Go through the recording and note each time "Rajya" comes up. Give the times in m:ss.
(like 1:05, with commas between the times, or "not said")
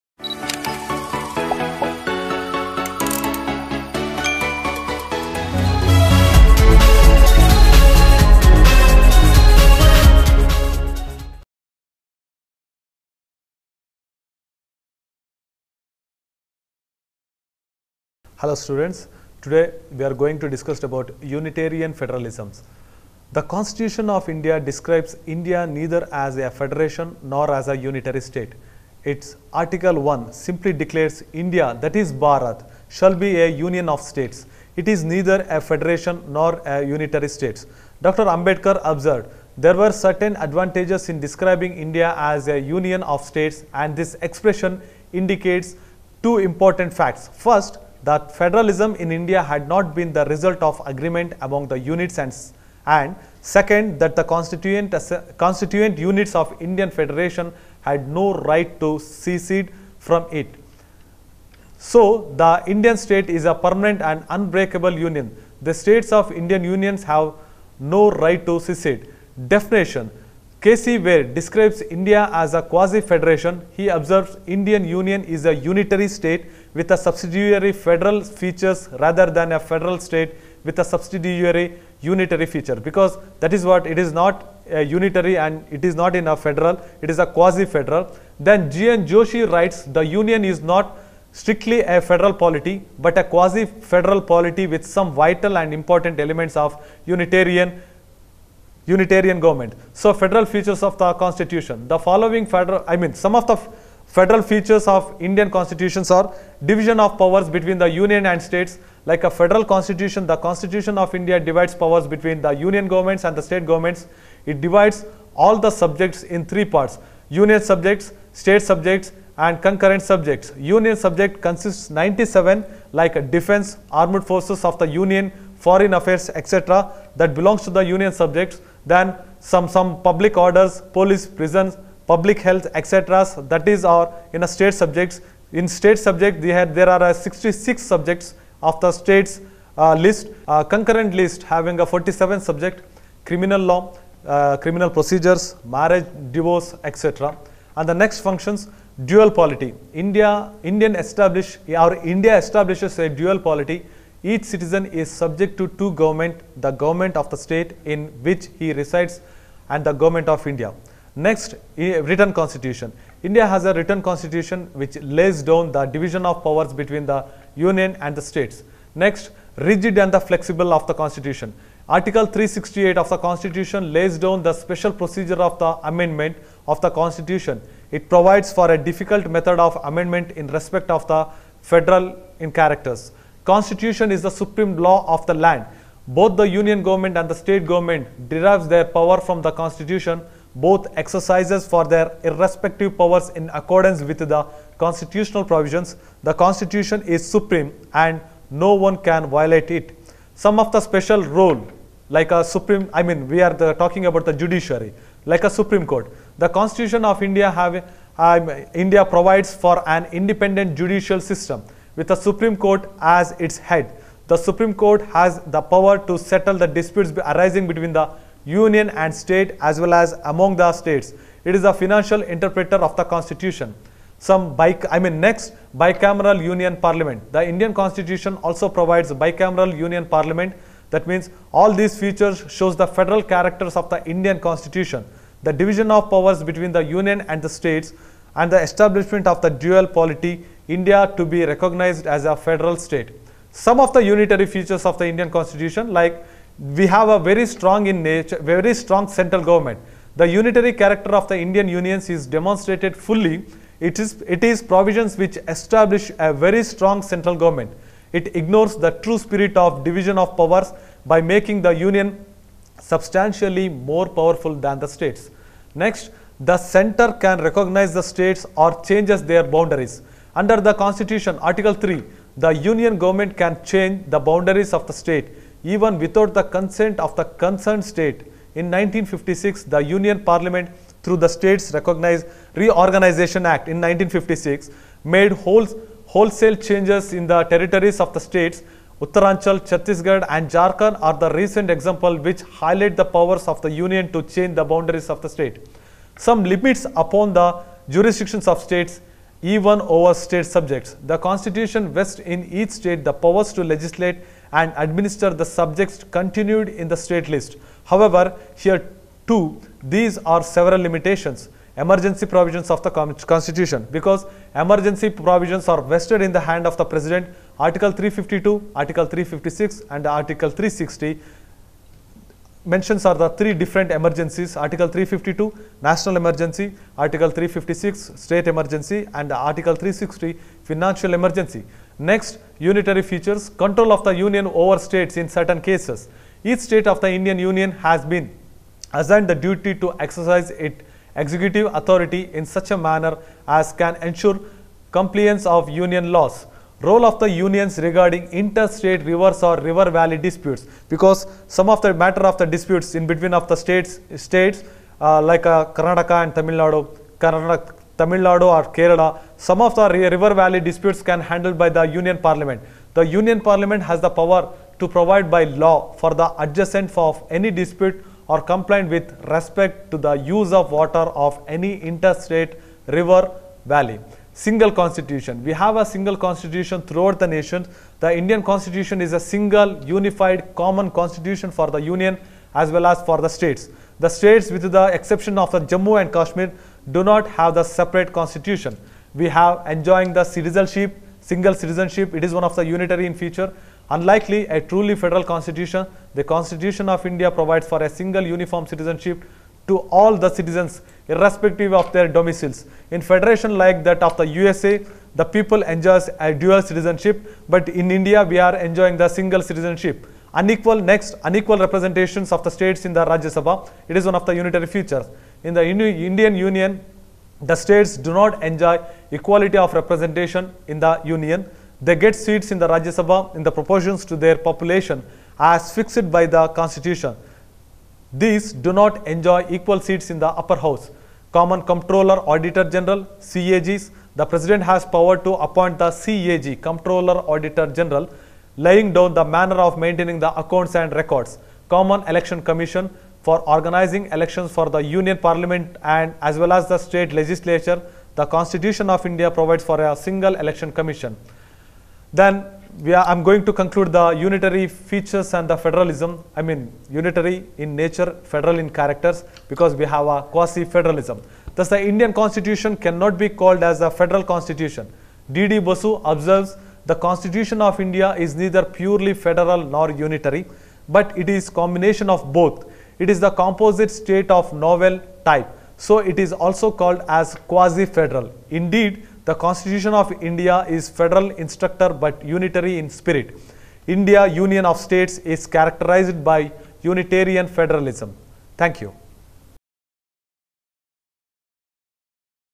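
6:53, 7:02.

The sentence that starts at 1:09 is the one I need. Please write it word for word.
Definition KC Wheare describes India as a quasi-federation.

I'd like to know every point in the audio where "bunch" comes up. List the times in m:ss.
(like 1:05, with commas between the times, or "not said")
not said.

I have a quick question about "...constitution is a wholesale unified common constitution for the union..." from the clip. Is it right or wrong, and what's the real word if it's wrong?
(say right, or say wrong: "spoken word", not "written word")
wrong: "single", not "wholesale".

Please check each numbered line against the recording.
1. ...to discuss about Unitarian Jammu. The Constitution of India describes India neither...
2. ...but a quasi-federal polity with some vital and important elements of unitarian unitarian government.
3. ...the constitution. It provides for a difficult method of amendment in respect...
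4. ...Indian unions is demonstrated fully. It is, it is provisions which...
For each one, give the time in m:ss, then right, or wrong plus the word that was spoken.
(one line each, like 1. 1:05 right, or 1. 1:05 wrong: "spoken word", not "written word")
1. 0:20 wrong: "Federalisms", not "Jammu"
2. 1:32 right
3. 2:56 right
4. 4:11 right.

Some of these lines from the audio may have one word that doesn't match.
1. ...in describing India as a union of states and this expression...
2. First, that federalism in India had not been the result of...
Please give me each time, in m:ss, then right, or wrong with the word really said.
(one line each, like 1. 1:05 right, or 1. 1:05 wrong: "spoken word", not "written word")
1. 0:41 right
2. 0:47 right.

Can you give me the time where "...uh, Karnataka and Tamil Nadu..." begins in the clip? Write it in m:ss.
5:55.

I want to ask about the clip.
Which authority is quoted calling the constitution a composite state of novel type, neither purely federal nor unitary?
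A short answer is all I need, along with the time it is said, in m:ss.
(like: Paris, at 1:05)
D.D. Basu, at 7:45.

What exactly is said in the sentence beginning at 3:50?
That means all these features shows the federal characters of the Indian constitution.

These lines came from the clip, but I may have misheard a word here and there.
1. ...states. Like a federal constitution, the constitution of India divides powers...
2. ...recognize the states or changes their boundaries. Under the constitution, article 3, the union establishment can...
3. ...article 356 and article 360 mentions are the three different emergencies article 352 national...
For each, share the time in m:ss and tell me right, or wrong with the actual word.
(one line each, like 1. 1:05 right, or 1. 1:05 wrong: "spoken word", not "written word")
1. 1:48 right
2. 4:27 wrong: "government", not "establishment"
3. 5:18 right.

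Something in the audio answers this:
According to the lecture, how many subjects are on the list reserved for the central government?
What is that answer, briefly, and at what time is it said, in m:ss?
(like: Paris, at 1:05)
97, at 2:01.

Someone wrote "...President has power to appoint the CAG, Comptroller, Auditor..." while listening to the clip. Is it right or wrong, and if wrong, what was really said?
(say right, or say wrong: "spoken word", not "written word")
right.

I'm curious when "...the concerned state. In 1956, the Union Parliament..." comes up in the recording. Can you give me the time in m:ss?
4:37.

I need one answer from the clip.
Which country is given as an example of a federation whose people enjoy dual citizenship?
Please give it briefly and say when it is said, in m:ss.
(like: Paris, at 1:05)
USA, at 6:44.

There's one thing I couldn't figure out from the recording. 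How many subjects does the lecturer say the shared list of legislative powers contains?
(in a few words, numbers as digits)
47.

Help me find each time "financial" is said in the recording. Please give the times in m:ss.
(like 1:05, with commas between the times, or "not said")
3:41, 5:30.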